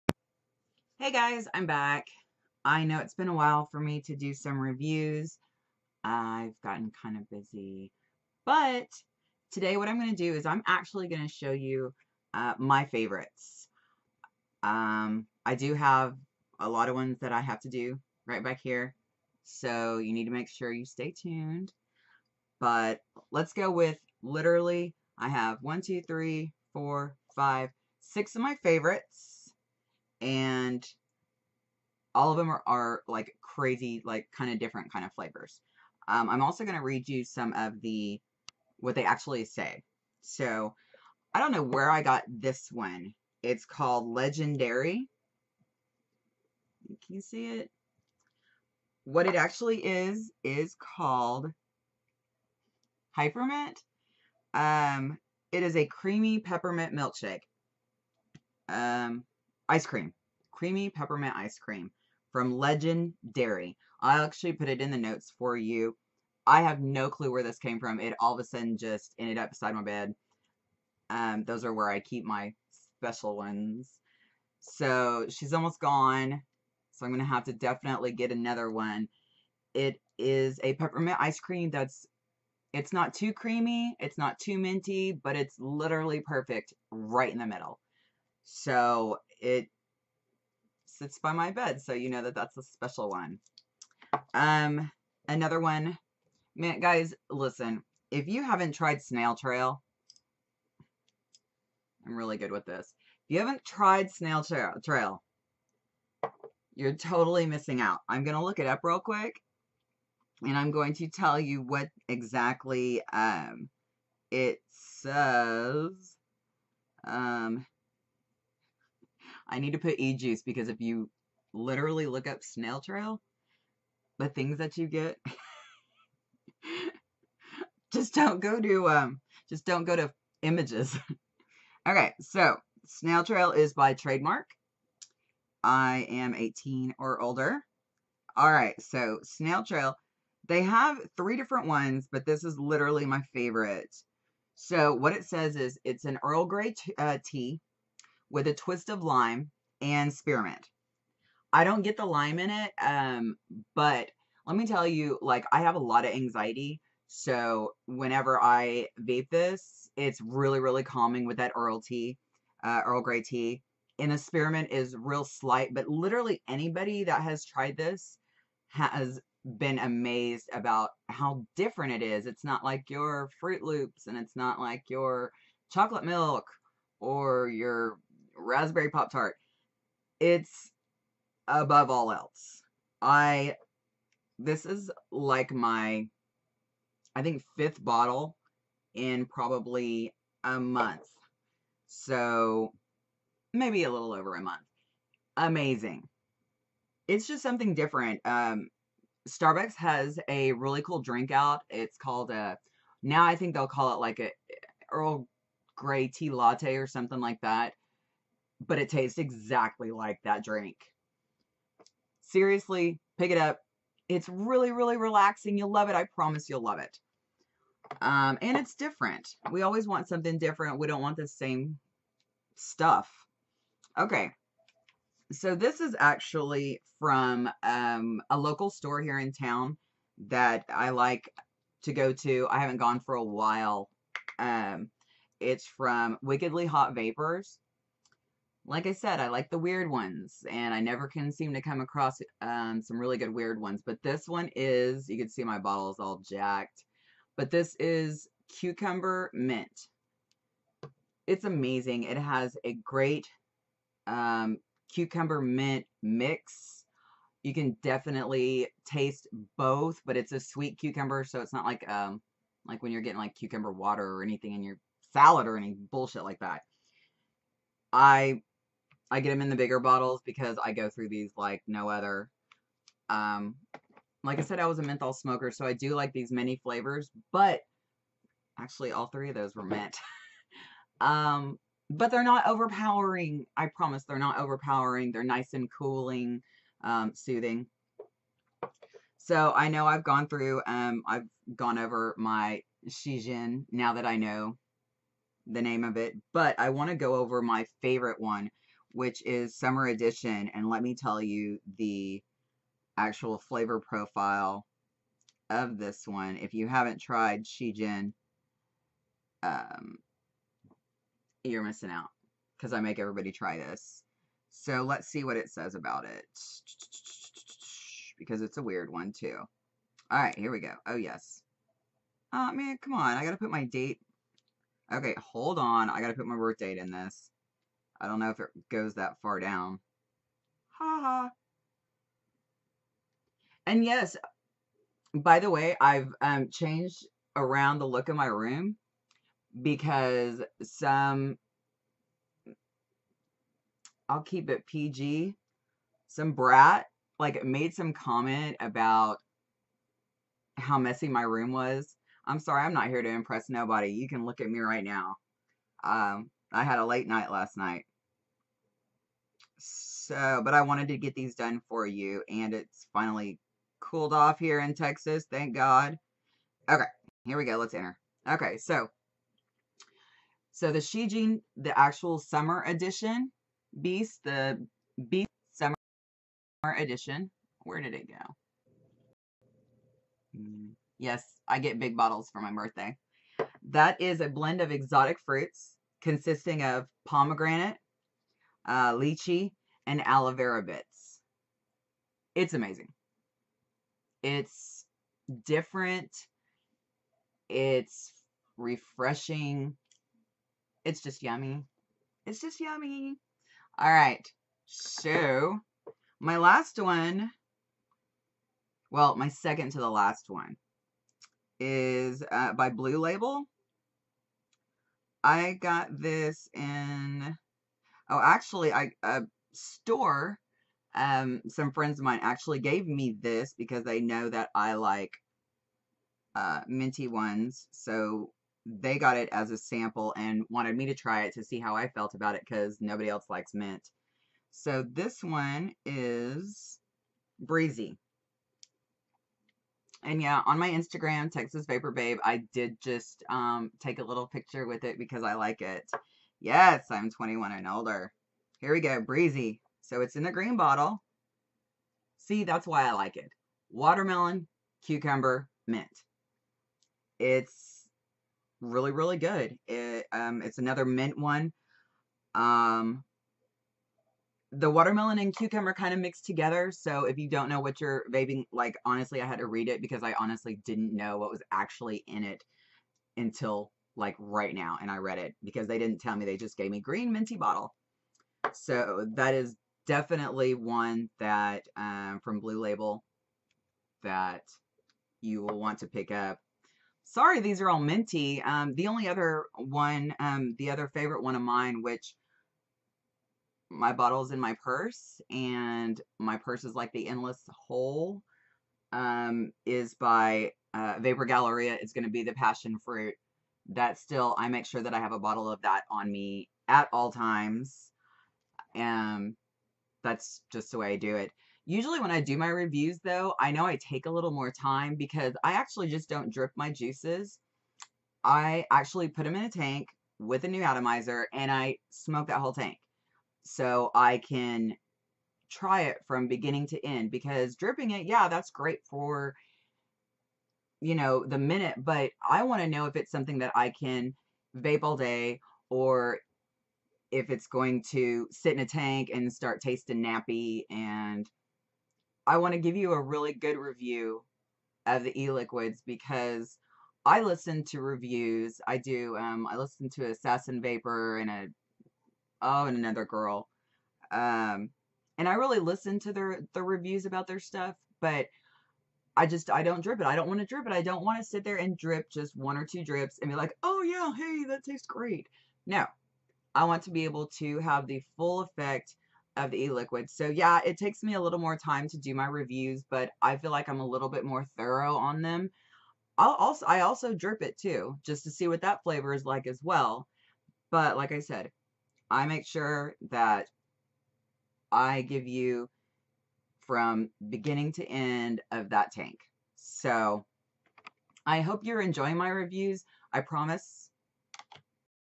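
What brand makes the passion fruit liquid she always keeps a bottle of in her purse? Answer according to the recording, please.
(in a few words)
Vapor Galleria.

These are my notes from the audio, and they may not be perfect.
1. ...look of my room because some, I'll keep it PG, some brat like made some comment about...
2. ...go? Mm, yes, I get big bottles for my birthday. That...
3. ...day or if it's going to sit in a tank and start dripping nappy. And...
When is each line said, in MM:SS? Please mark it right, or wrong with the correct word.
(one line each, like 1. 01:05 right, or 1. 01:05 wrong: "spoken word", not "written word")
1. 05:37 right
2. 06:18 right
3. 08:54 wrong: "tasting", not "dripping".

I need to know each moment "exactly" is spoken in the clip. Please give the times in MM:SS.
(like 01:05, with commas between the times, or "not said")
01:52, 03:29.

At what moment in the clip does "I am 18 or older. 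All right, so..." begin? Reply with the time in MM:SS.
02:15.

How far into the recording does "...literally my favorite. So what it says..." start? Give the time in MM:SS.
02:22.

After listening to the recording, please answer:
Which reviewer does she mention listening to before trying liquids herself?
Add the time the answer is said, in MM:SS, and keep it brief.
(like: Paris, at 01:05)
Assassin Vapor, at 09:10.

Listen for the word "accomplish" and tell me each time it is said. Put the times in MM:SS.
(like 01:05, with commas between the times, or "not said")
not said.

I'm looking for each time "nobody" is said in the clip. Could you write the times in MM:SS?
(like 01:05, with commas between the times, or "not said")
05:53, 07:12.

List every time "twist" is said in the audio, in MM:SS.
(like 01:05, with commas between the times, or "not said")
02:28.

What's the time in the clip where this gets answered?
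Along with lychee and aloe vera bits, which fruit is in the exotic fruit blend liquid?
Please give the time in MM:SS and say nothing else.
06:27.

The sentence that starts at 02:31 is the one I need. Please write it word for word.
I don't get the lime in it, um, but let me tell you, like, I have a lot of anxiety.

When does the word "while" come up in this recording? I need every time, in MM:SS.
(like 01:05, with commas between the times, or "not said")
00:03, 03:53.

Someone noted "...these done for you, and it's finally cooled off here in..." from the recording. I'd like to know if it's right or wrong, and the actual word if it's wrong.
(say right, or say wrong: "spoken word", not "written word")
right.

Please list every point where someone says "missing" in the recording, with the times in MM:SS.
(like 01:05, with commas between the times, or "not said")
01:47, 05:11.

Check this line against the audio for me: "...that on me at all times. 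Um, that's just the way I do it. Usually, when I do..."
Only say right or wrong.
right.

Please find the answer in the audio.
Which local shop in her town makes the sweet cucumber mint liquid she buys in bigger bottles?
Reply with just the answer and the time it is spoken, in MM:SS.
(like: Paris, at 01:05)
Wickedly Hot Vapors, at 03:56.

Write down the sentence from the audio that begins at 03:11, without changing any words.
So maybe a little over a month.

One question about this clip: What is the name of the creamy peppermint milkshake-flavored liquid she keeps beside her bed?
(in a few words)
Heifermint.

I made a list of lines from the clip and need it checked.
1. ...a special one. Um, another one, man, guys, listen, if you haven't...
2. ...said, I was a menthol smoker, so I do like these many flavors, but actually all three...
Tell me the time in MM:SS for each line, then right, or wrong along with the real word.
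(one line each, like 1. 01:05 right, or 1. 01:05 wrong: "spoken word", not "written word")
1. 01:32 right
2. 04:34 right.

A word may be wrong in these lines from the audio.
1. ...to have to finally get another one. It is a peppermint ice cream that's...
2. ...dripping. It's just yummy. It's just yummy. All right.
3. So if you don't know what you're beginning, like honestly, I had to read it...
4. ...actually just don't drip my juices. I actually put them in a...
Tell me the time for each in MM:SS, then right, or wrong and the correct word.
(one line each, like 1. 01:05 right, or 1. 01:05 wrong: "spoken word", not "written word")
1. 01:17 wrong: "definitely", not "finally"
2. 06:38 wrong: "refreshing", not "dripping"
3. 07:46 wrong: "vaping", not "beginning"
4. 08:35 right.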